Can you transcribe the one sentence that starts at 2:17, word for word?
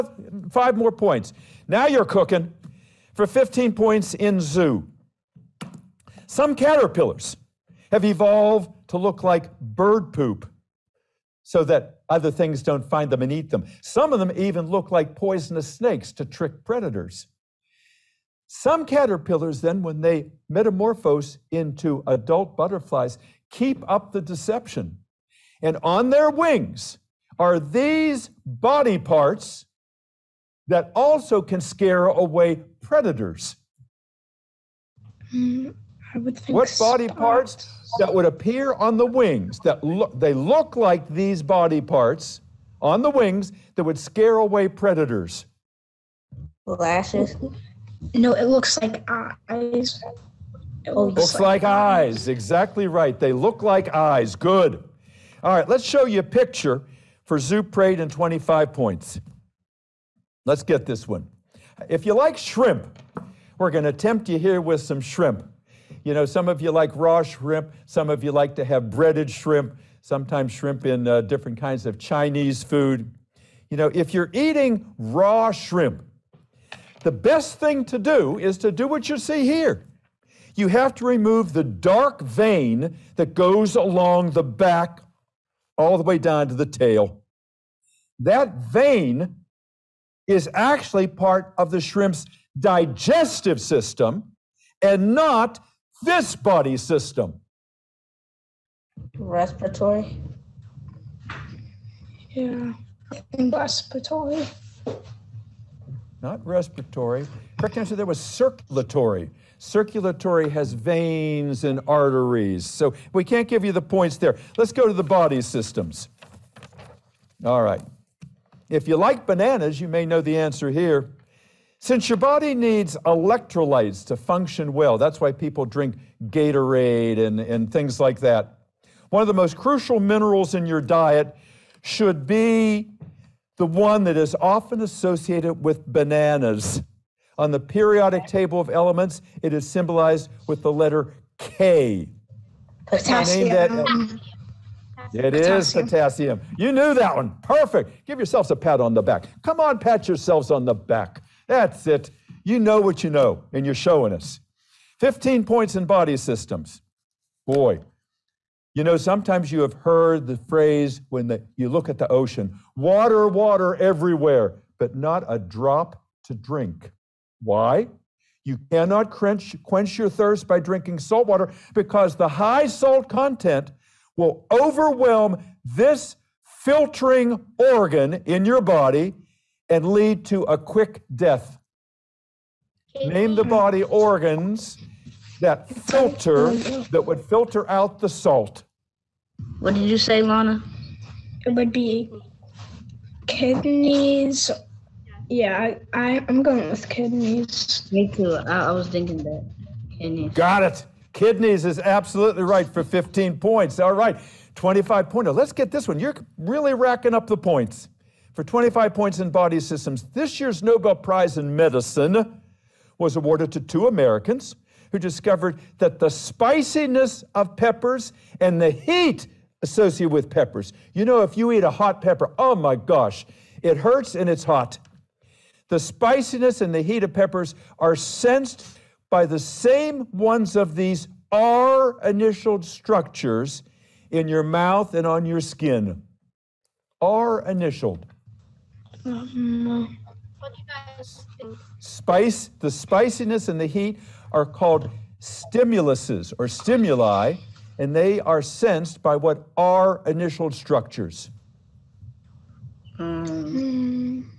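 On the periodic table of elements, it is symbolized with the letter K.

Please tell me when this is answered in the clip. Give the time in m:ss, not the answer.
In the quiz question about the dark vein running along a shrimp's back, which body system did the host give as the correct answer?
1:47.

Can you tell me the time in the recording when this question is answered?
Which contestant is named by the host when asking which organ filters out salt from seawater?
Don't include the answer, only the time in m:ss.
3:10.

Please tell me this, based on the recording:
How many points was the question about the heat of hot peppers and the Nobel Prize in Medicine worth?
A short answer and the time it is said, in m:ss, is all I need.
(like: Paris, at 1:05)
25, at 3:28.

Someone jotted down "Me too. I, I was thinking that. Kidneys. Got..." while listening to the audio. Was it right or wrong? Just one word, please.
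right.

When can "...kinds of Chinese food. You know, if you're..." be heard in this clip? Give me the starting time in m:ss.
1:11.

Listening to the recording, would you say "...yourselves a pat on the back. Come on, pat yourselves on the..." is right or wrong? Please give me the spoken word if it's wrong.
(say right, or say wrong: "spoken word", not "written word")
right.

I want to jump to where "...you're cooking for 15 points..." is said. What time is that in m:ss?
0:01.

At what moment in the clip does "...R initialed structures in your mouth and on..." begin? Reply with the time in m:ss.
3:51.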